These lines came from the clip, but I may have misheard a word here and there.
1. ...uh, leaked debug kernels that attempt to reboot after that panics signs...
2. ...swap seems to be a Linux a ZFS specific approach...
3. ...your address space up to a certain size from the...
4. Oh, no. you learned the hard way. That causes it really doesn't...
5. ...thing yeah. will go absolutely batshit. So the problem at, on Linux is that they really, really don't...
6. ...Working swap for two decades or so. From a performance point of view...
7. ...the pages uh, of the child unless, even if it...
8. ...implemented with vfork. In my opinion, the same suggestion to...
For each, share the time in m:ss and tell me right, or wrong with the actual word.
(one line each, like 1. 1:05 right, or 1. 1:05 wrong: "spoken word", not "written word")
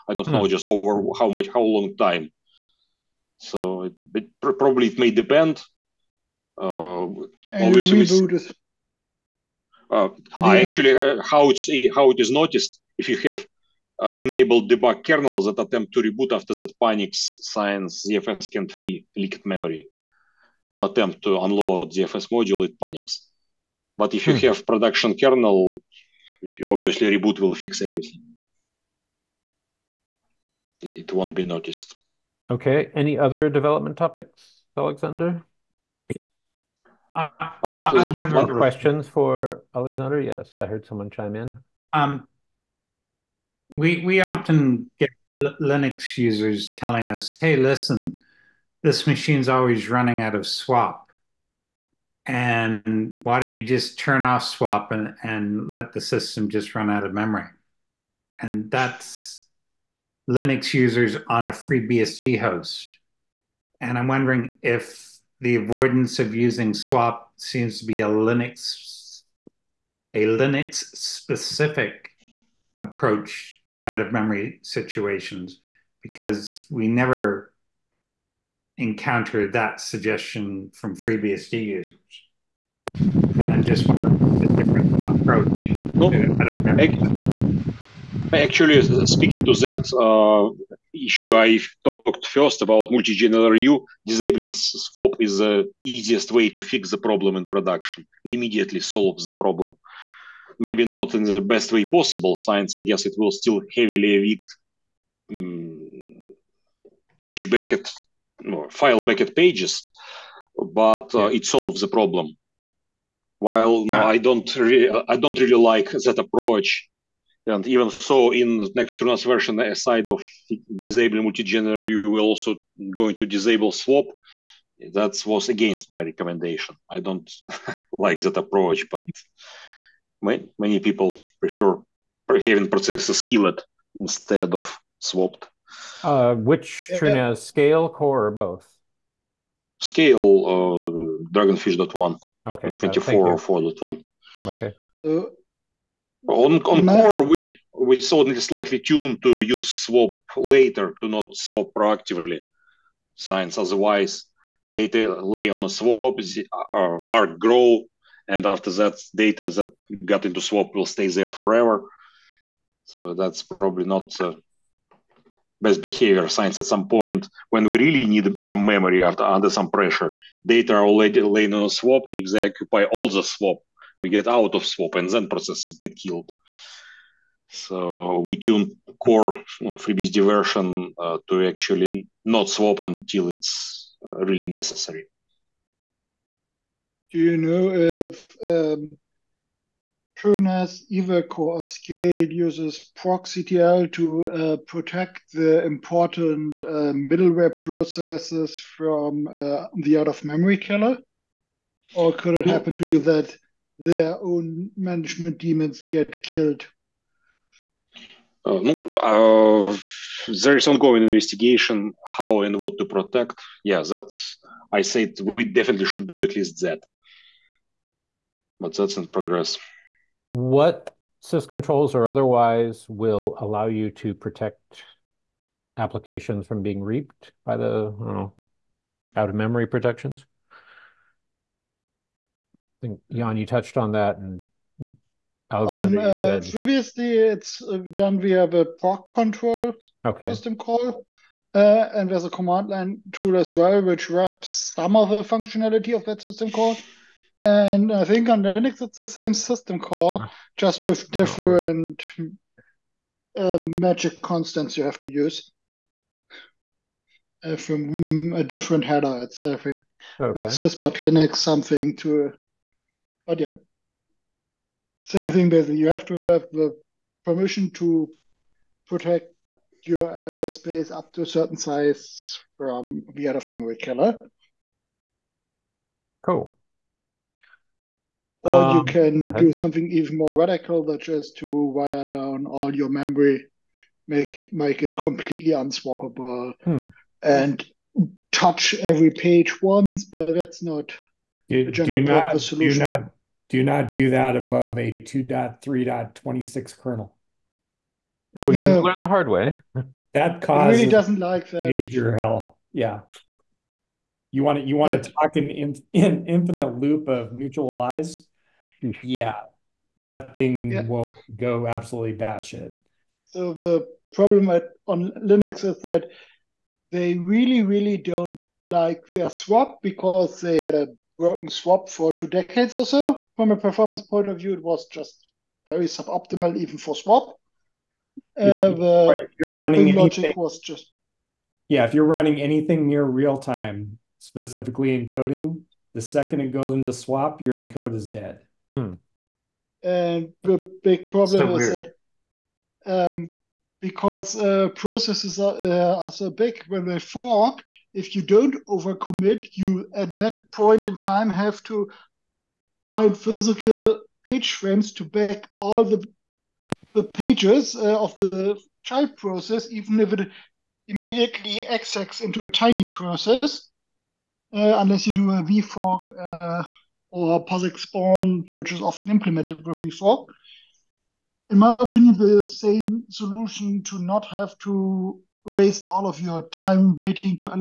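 1. 0:14 wrong: "enabled", not "leaked"
2. 1:06 wrong: "Linux", not "ZFS"
3. 4:29 right
4. 4:58 right
5. 5:10 right
6. 5:21 right
7. 5:56 wrong: "process", not "unless"
8. 6:09 wrong: "solution", not "suggestion".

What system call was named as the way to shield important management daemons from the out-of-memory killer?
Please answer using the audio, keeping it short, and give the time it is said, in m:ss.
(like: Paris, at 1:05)
procctl, at 3:12.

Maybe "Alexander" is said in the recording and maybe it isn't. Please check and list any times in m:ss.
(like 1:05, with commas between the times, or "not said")
0:34, 0:39, 3:55.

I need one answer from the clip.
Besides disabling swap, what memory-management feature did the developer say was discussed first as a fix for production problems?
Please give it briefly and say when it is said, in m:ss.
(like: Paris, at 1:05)
multi-gen LRU, at 1:32.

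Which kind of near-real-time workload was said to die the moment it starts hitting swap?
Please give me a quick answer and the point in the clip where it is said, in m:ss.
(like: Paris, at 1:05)
encoding, at 5:35.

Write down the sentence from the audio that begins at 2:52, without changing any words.
If they occupy all the swap, we get out of swap and then processes get killed.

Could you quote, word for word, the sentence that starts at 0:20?
On attempt to unload ZFS module, it panics.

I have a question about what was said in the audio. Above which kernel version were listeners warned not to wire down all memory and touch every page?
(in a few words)
2.3.26.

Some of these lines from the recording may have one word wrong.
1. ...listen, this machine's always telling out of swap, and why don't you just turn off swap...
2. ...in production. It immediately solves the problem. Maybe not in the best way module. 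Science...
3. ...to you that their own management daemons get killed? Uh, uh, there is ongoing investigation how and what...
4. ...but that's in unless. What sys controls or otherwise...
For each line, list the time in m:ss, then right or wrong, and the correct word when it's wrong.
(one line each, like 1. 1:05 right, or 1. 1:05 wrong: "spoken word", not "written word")
1. 0:47 wrong: "running", not "telling"
2. 1:37 wrong: "possible", not "module"
3. 3:22 right
4. 3:38 wrong: "progress", not "unless".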